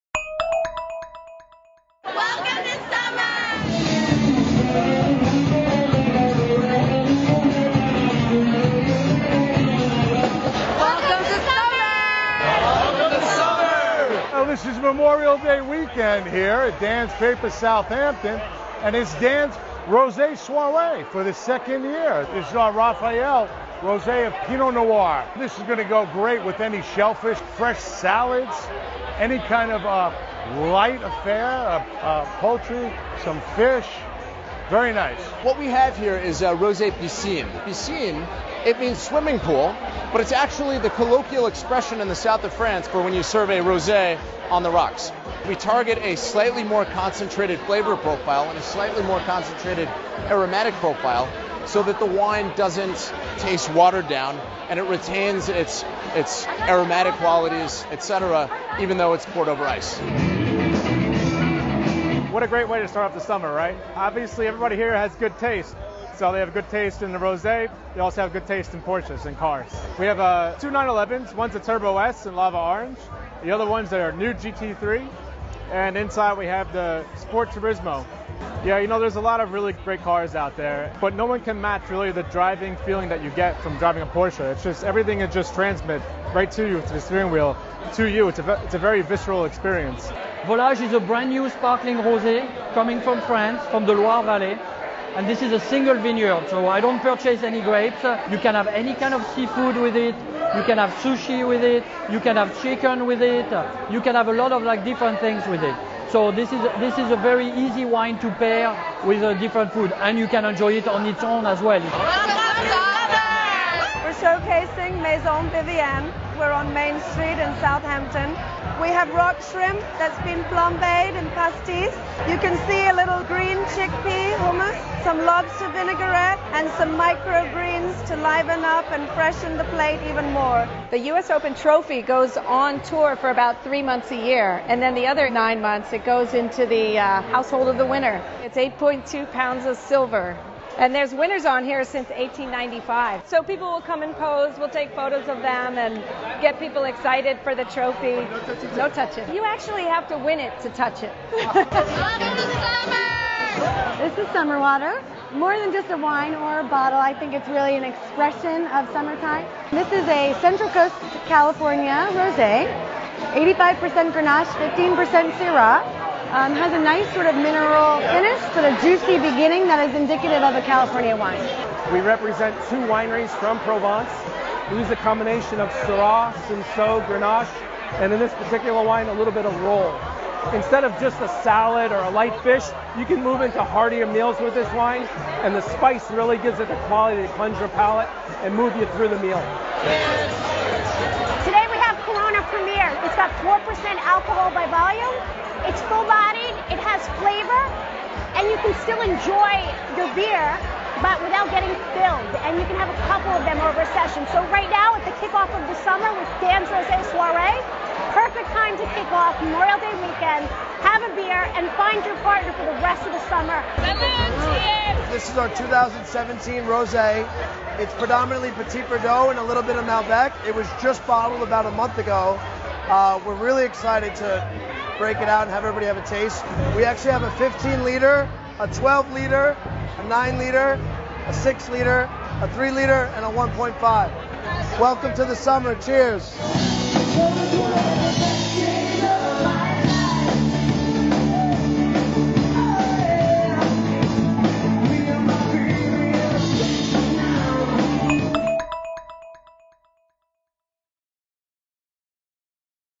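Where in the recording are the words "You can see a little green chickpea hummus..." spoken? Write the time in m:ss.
2:02.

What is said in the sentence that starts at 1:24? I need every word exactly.
It's just everything is just transmit right to you, to the steering wheel, to you.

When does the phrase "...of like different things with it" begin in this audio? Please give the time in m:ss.
1:44.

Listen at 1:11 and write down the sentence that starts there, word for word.
One's a Turbo S in lava orange.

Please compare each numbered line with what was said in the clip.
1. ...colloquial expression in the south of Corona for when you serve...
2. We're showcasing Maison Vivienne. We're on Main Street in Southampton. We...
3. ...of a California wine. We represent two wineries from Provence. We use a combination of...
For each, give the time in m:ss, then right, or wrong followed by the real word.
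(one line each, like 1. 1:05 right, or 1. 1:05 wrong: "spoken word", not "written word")
1. 0:40 wrong: "France", not "Corona"
2. 1:54 right
3. 2:50 right.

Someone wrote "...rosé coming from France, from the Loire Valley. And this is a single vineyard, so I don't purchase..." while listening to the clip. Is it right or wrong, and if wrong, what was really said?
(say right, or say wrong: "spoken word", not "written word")
right.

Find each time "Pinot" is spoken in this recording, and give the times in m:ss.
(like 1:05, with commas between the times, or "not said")
0:24.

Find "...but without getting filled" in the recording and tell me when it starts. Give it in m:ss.
3:20.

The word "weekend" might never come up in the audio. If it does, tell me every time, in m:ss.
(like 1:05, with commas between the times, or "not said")
0:15, 3:30.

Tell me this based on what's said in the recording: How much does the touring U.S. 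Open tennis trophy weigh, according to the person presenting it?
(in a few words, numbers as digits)
8.2 pounds.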